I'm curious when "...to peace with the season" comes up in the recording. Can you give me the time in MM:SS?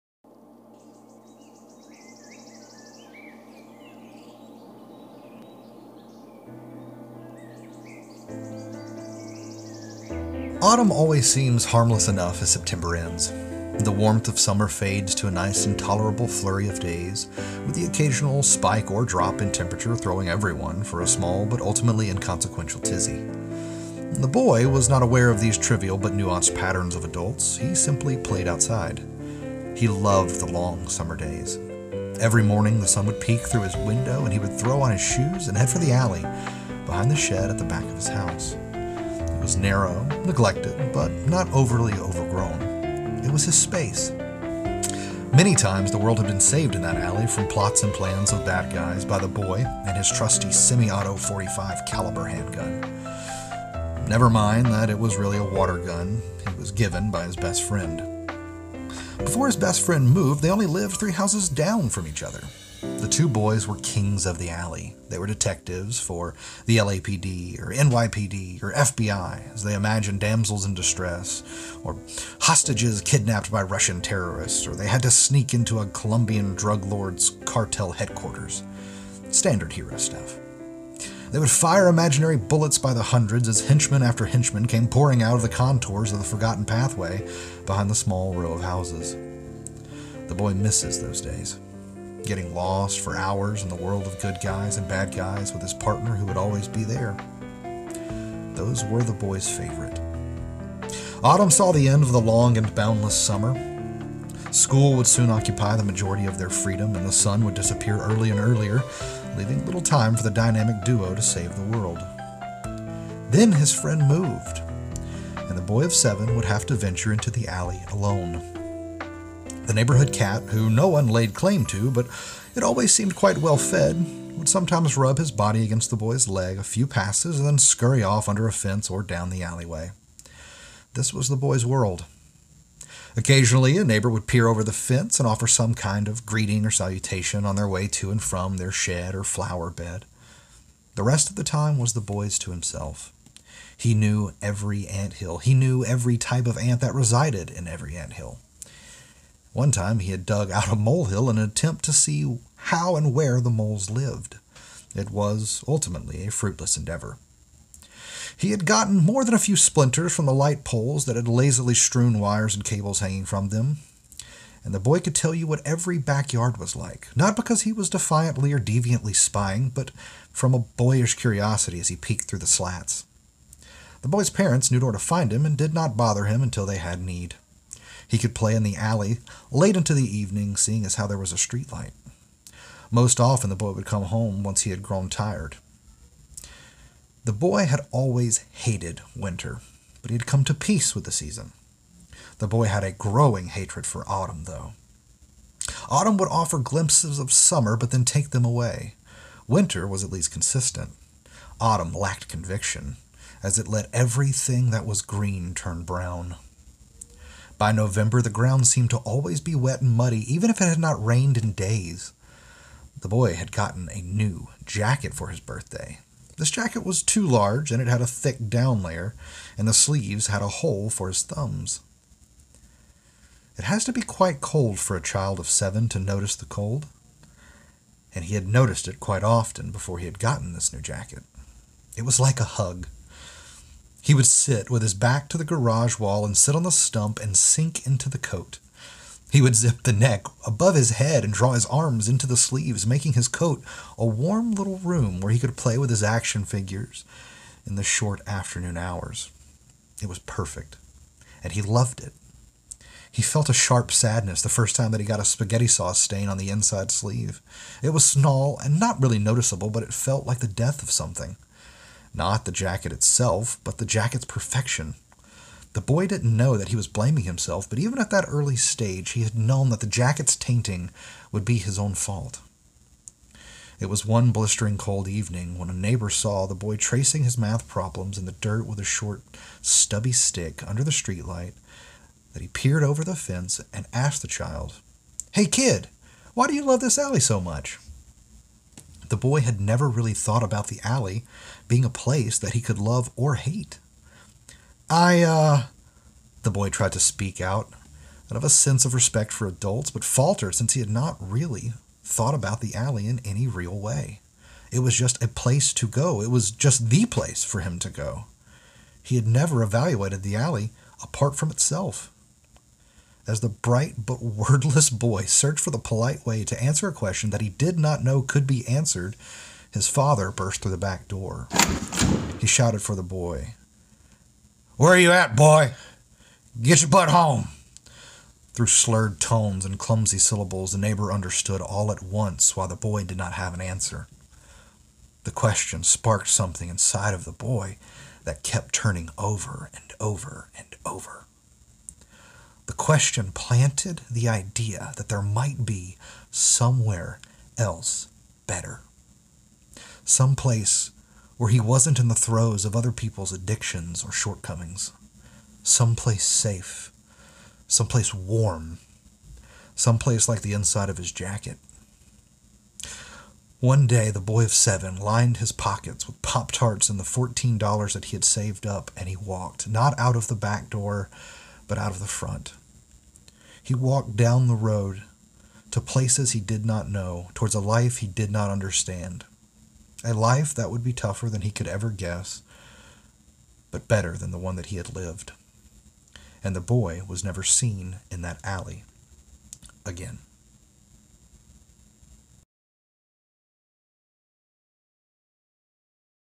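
03:10.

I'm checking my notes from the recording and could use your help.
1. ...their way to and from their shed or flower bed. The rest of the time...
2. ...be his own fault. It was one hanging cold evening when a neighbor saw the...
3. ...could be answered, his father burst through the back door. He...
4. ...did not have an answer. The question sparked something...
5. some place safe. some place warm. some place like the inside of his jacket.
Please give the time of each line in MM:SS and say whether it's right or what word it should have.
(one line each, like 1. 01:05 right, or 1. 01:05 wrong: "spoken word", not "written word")
1. 02:17 right
2. 04:31 wrong: "blistering", not "hanging"
3. 05:18 right
4. 05:33 right
5. 05:55 right.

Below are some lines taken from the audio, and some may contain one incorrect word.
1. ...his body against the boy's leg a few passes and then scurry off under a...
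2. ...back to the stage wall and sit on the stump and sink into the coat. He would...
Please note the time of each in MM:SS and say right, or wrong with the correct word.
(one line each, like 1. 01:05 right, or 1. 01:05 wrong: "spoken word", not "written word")
1. 02:05 right
2. 03:54 wrong: "garage", not "stage".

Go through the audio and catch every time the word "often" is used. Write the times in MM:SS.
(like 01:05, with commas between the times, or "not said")
03:03, 03:49.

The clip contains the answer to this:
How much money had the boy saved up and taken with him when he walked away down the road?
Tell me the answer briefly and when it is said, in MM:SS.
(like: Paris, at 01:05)
$14, at 06:07.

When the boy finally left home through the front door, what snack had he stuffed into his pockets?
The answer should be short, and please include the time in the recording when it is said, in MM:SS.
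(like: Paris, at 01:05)
Pop Tarts, at 06:06.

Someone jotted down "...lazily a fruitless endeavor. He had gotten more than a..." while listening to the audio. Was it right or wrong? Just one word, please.
wrong.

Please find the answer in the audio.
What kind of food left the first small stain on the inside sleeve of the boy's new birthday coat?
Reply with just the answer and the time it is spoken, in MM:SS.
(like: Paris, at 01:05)
Spaghetti sauce, at 04:15.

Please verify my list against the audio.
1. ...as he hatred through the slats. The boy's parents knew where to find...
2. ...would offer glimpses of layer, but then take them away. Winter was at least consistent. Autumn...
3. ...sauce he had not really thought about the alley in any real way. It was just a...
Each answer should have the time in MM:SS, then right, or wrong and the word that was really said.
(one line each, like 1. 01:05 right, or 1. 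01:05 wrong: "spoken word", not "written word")
1. 02:51 wrong: "peeked", not "hatred"
2. 03:16 wrong: "summer", not "layer"
3. 05:00 wrong: "since", not "sauce".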